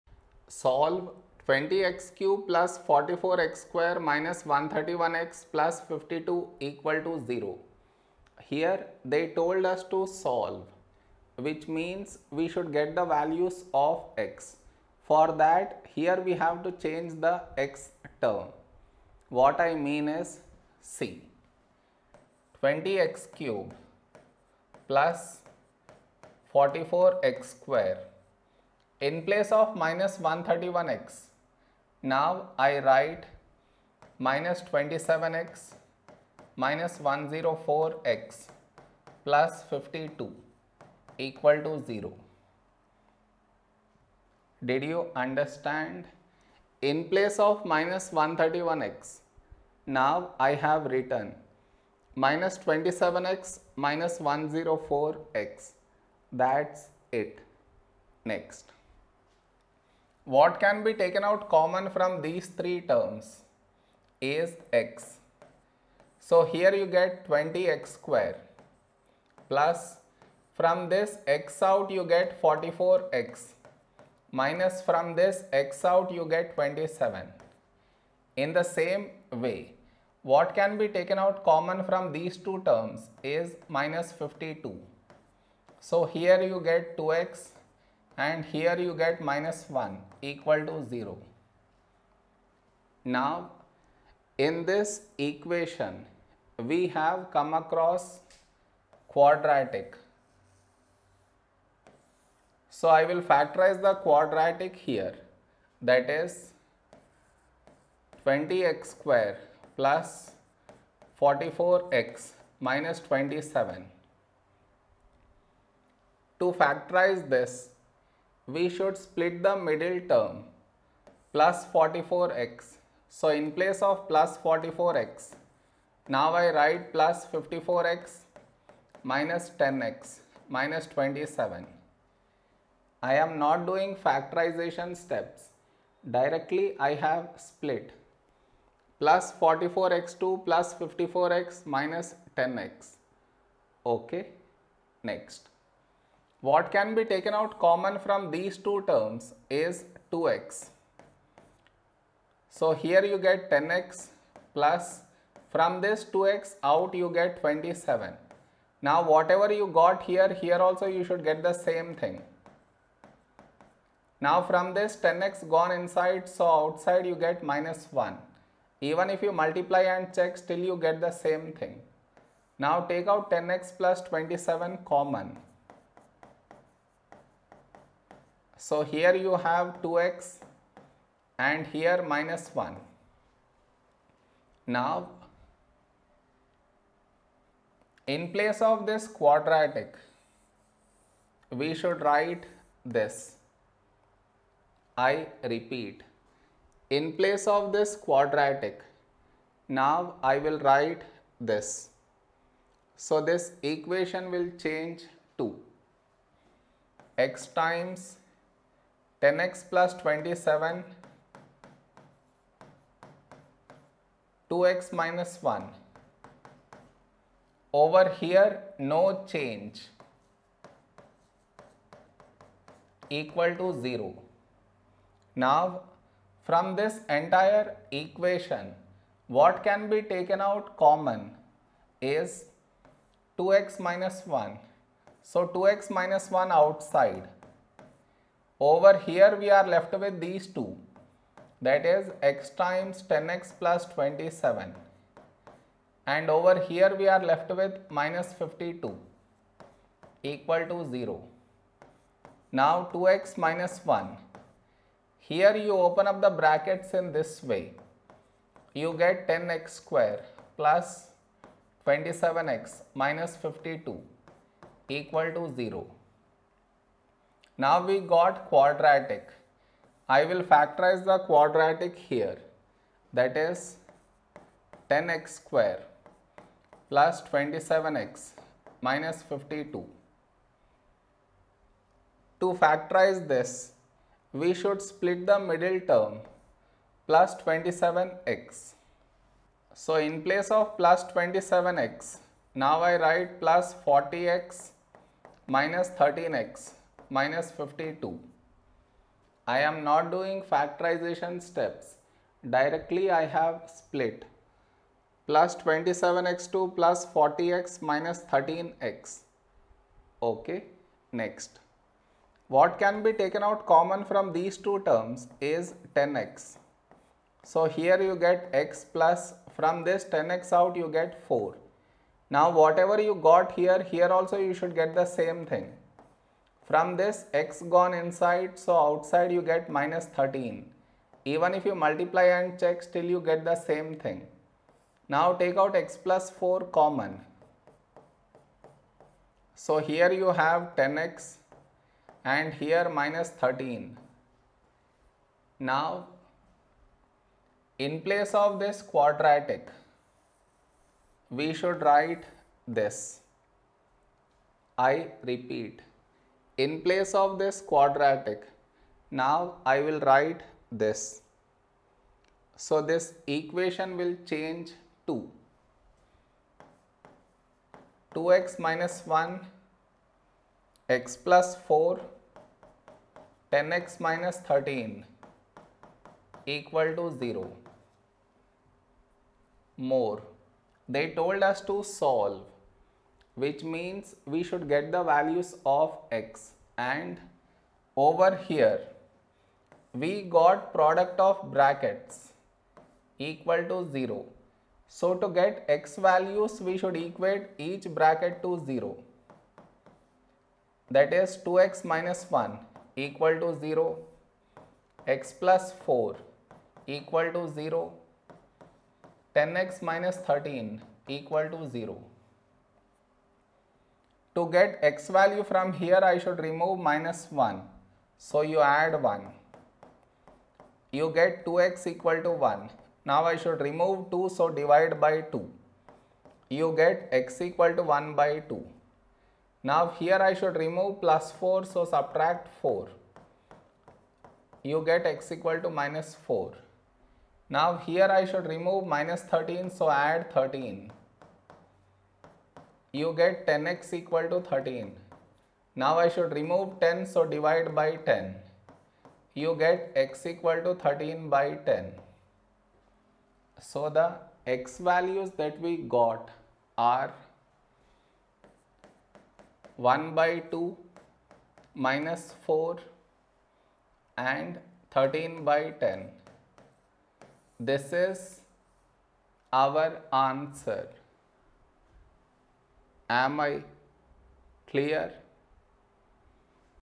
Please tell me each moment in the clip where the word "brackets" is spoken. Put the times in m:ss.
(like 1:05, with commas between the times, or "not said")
4:16, 6:31, 6:37.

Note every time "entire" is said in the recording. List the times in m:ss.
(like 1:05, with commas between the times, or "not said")
3:47.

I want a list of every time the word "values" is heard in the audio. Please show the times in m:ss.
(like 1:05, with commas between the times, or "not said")
0:13, 6:25, 6:35, 6:55, 7:34.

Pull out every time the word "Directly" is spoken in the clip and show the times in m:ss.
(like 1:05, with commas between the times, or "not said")
2:16, 5:02.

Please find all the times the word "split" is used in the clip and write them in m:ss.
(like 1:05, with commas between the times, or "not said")
1:58, 2:17, 4:44, 5:03.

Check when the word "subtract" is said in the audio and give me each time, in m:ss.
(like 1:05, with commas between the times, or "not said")
7:11.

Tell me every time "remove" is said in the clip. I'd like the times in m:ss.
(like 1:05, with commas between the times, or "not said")
6:56, 7:03, 7:10, 7:18, 7:26.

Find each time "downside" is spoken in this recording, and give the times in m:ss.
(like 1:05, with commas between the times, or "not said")
not said.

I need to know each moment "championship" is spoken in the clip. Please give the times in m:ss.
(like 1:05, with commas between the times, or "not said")
not said.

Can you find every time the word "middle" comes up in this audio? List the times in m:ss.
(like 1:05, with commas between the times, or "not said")
1:59, 4:45.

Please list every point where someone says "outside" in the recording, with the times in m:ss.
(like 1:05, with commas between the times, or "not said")
2:46, 3:56, 5:28.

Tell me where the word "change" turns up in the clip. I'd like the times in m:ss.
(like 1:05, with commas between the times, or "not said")
0:16, 3:24, 3:39, 6:04.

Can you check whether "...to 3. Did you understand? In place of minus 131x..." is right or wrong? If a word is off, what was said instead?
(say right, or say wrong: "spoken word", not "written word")
wrong: "0", not "3".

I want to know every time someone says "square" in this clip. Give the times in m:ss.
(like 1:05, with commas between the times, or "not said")
0:03, 0:27, 1:07, 1:48, 4:19, 4:35.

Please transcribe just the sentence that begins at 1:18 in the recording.
In the same way, what can be taken out common from these two terms is minus 52.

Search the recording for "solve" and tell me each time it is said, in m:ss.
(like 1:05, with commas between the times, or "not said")
0:00, 0:10, 6:21.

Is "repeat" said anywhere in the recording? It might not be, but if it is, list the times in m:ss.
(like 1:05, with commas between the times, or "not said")
3:15, 5:55.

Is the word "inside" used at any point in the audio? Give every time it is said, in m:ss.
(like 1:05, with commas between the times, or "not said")
2:45, 5:27.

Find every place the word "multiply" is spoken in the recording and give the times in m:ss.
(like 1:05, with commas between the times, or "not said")
2:49, 5:31.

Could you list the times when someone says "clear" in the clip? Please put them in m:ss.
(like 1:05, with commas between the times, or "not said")
7:54.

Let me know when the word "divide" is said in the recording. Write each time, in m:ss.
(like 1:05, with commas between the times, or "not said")
7:04, 7:27.